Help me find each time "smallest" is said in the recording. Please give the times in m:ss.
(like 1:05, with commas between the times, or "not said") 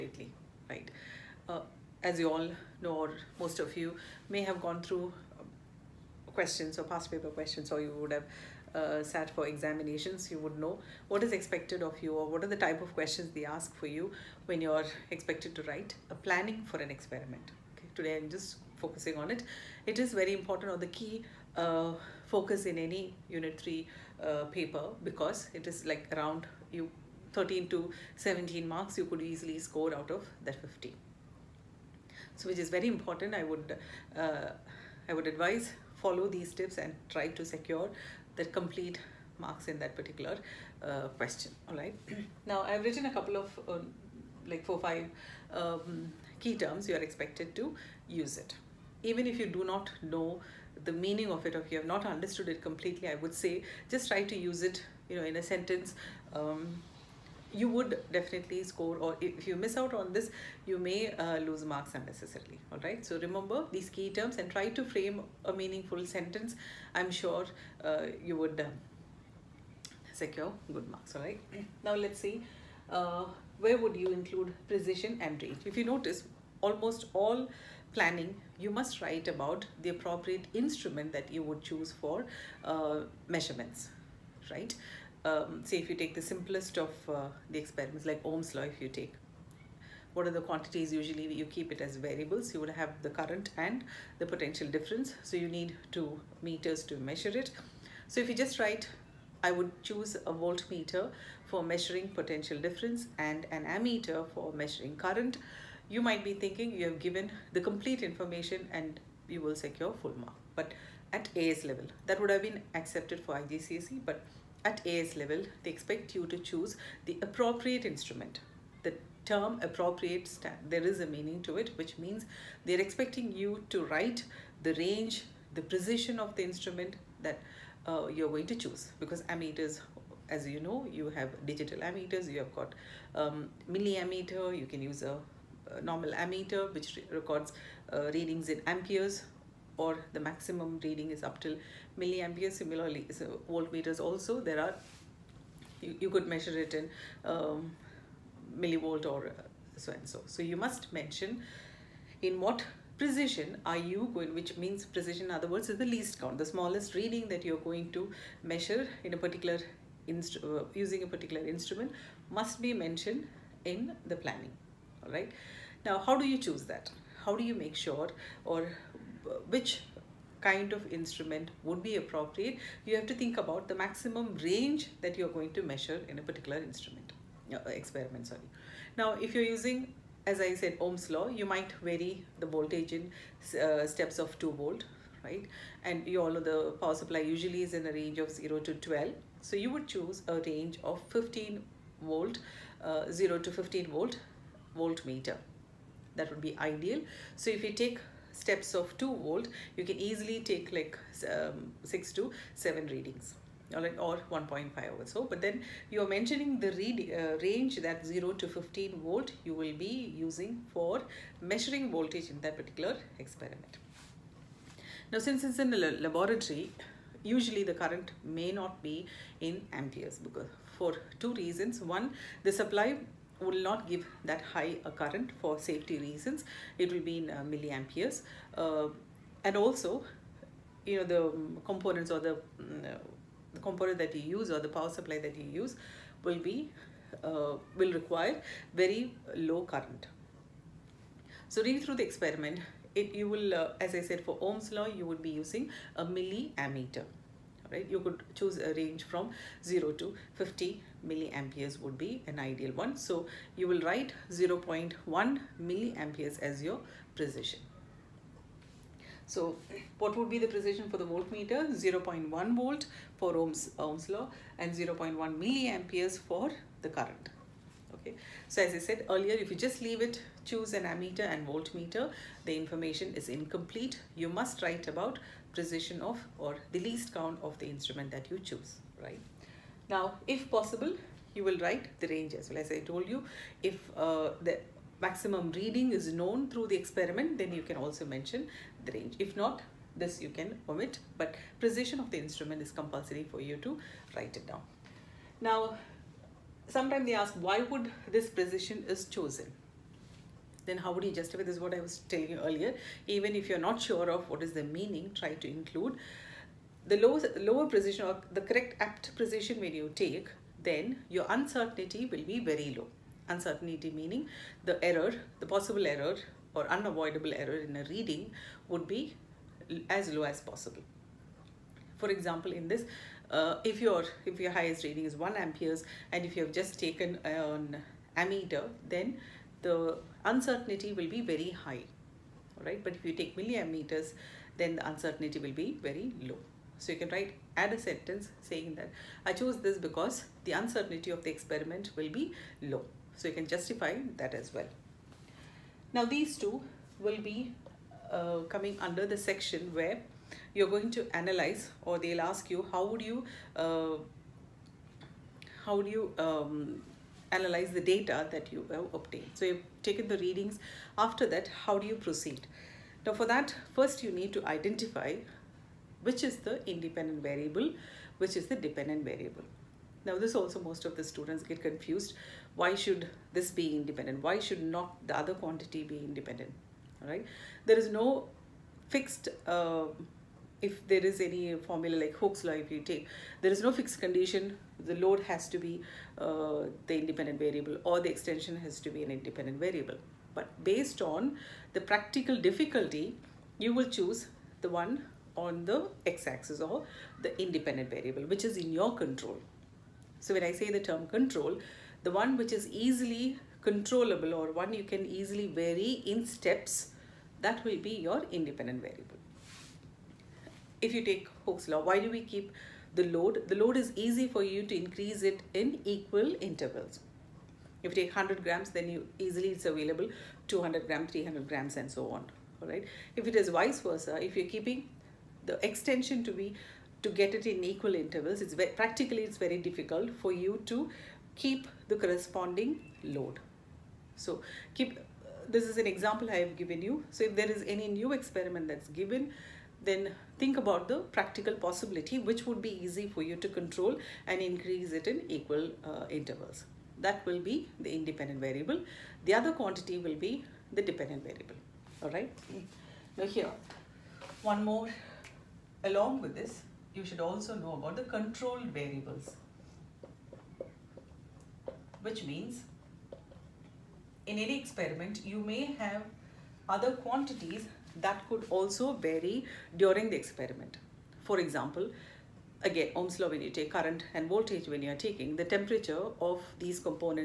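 2:36.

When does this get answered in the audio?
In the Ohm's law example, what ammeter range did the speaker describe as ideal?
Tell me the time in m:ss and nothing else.
4:09.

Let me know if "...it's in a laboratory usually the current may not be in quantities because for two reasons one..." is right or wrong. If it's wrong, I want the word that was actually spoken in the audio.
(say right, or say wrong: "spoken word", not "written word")
wrong: "amperes", not "quantities".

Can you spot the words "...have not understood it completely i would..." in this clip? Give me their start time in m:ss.
0:51.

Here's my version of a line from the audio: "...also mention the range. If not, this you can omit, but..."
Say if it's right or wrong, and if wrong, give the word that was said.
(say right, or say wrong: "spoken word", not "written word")
right.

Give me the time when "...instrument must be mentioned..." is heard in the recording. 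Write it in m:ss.
2:41.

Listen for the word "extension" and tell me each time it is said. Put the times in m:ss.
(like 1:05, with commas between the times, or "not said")
6:28, 7:05.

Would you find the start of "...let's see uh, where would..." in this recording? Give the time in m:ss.
1:11.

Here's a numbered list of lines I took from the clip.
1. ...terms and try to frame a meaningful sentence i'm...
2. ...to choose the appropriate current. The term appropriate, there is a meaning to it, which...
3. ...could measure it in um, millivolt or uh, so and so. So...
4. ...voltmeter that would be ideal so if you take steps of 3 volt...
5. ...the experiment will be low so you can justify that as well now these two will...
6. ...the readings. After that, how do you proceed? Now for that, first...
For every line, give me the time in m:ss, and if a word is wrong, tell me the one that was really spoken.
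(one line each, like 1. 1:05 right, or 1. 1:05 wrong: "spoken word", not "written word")
1. 1:04 right
2. 1:56 wrong: "instrument", not "current"
3. 2:26 right
4. 3:14 wrong: "2", not "3"
5. 5:41 right
6. 6:00 right.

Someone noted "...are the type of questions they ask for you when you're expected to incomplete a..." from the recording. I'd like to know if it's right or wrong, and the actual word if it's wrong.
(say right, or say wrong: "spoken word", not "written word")
wrong: "write", not "incomplete".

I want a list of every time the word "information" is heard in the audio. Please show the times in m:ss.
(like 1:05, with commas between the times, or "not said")
1:48, 4:32.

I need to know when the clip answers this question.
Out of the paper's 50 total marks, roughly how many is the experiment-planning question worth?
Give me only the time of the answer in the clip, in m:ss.
0:27.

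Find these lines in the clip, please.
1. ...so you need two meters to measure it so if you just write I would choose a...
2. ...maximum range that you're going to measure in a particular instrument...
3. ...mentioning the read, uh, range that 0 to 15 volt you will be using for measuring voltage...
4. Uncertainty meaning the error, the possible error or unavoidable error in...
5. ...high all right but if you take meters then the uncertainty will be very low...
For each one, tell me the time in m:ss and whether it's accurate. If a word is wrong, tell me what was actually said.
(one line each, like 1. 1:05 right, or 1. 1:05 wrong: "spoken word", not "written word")
1. 1:35 right
2. 2:53 right
3. 3:26 right
4. 5:13 right
5. 5:31 wrong: "milliammeters", not "meters".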